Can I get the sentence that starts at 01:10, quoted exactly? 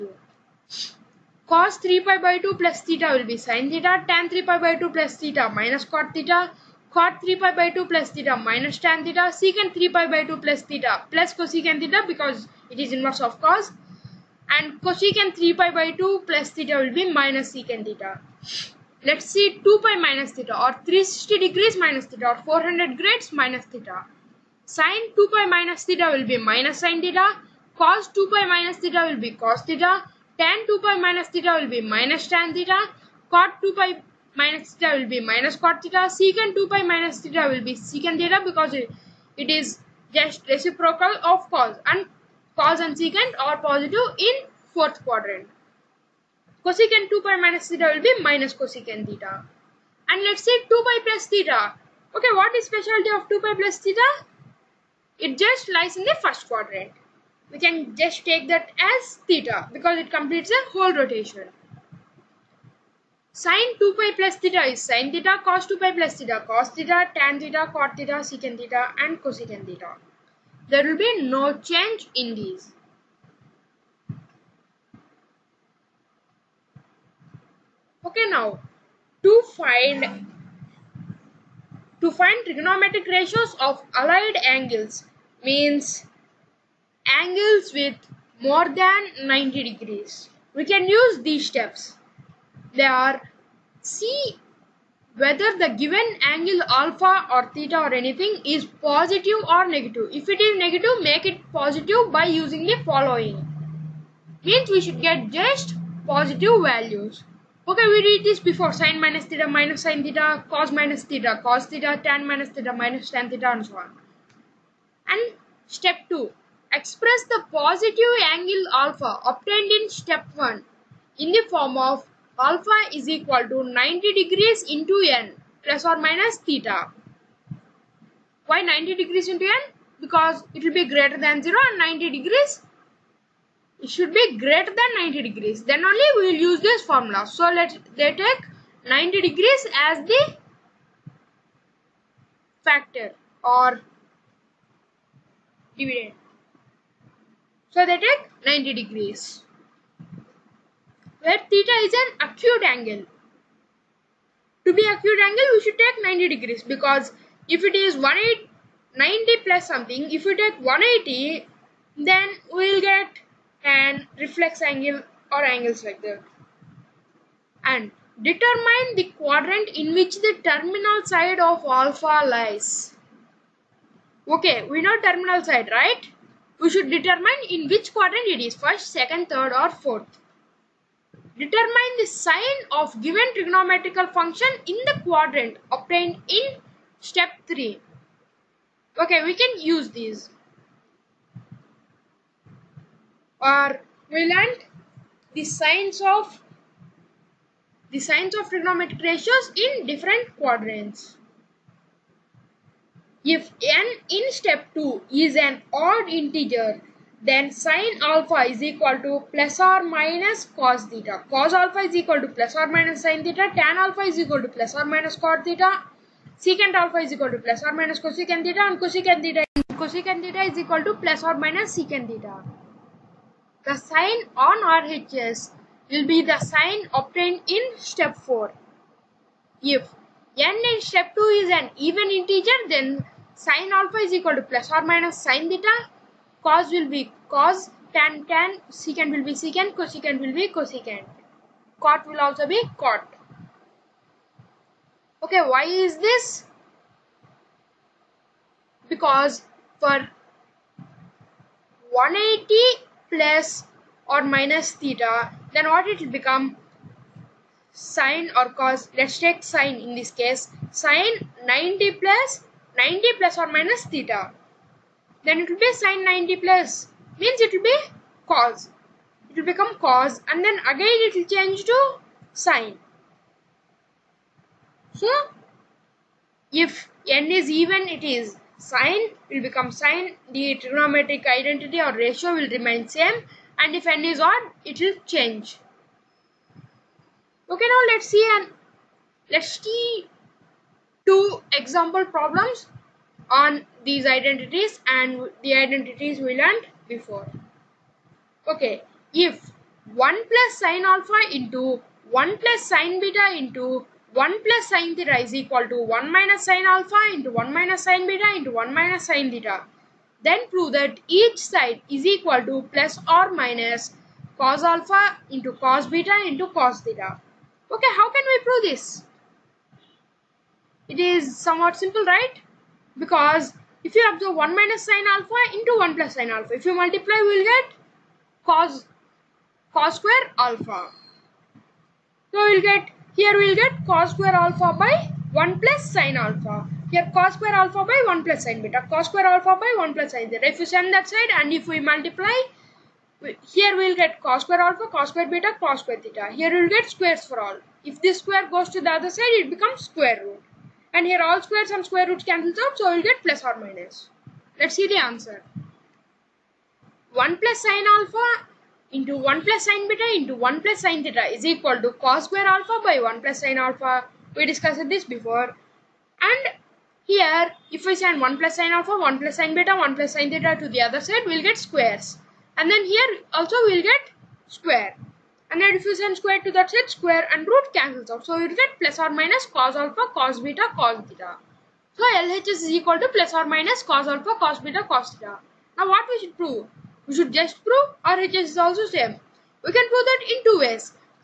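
There will be no change in these.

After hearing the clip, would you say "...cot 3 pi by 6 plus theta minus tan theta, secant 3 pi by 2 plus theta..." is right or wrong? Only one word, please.
wrong.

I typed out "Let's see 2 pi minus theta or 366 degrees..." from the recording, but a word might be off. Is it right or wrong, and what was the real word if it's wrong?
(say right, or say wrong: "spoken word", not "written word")
wrong: "360", not "366".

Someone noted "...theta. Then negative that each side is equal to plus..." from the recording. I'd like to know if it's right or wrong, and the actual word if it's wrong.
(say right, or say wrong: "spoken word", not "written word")
wrong: "prove", not "negative".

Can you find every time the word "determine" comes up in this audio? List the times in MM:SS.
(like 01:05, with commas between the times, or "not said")
02:48, 02:56, 03:01.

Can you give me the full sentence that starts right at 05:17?
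Okay, how can we prove this?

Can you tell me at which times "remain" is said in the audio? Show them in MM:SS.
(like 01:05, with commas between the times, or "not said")
04:42.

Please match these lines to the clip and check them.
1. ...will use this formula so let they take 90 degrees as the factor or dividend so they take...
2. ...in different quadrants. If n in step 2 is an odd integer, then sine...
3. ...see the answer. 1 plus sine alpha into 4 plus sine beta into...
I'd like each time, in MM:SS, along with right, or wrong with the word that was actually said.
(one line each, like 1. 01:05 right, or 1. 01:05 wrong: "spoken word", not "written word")
1. 02:16 right
2. 03:19 right
3. 05:54 wrong: "1", not "4".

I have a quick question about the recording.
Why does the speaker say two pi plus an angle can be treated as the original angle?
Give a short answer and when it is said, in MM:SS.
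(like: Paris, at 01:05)
It completes a whole rotation, at 01:00.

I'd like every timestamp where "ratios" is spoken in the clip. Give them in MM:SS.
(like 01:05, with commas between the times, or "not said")
01:23, 03:19, 04:41.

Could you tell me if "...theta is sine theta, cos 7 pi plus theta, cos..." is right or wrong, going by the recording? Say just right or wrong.
wrong.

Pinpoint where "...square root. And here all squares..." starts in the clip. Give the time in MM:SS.
05:49.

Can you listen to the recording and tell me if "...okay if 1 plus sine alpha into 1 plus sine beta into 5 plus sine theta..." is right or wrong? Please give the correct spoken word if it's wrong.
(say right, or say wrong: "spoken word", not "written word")
wrong: "1", not "5".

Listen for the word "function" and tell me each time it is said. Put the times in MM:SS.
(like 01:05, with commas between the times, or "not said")
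03:04.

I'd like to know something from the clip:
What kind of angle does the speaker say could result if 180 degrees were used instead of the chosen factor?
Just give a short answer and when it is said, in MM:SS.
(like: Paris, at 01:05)
Reflex angle, at 02:44.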